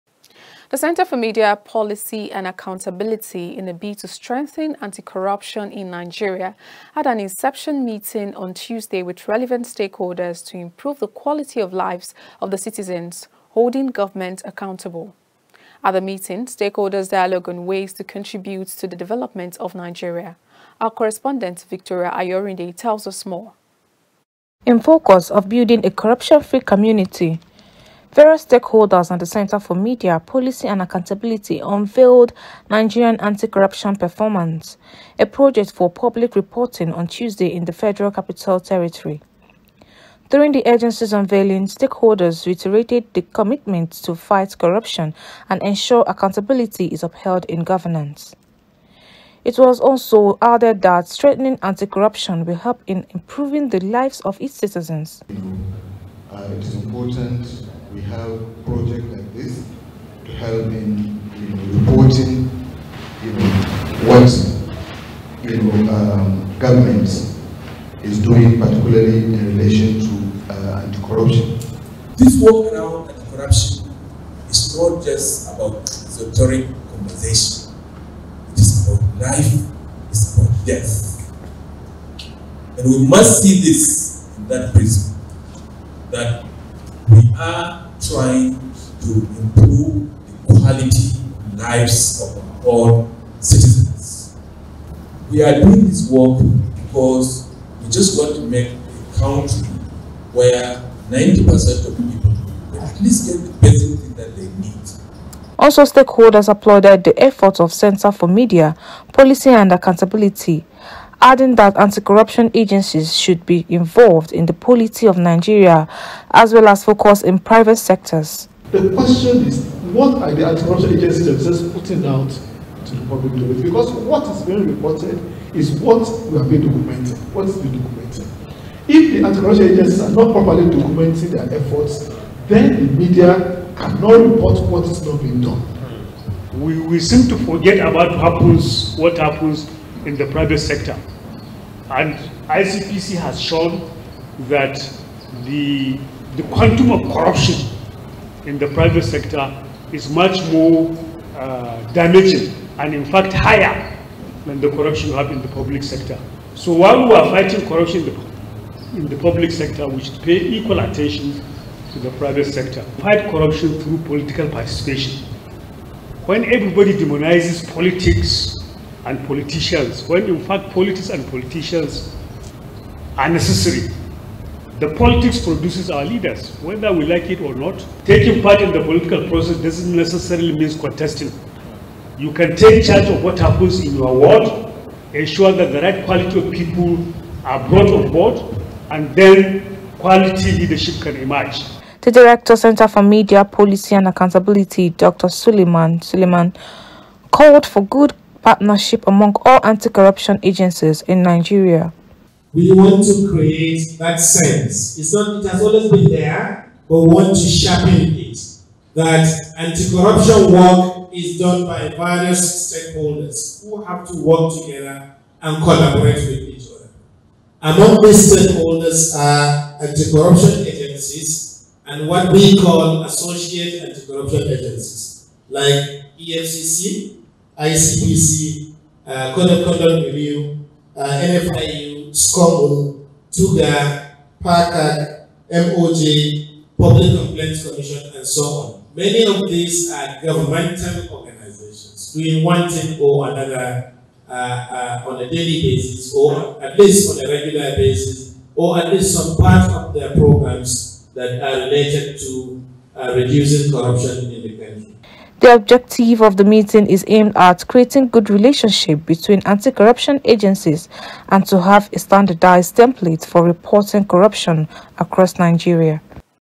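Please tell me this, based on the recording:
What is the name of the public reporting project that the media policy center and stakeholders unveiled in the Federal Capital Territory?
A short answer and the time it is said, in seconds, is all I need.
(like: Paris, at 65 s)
Nigerian Anti-Corruption Performance, at 32 s.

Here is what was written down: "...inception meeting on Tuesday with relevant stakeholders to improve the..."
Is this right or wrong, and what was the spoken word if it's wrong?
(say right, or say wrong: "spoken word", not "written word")
right.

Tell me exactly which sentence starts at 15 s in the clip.
At the meeting, stakeholders dialogue on ways to contribute to the development of Nigeria.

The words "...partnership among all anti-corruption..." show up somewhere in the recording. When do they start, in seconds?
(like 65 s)
198 s.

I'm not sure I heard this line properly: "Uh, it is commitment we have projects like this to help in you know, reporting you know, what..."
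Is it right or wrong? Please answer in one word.
wrong.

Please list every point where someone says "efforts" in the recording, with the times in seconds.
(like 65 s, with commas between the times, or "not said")
107 s, 131 s.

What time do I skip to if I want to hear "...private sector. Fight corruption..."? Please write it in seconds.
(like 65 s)
162 s.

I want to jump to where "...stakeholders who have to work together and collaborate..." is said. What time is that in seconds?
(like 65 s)
212 s.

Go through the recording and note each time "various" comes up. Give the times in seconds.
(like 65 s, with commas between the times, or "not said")
28 s, 211 s.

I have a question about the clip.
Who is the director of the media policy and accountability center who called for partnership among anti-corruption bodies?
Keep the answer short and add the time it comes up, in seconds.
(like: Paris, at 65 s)
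Dr. Suleiman Suleiman, at 194 s.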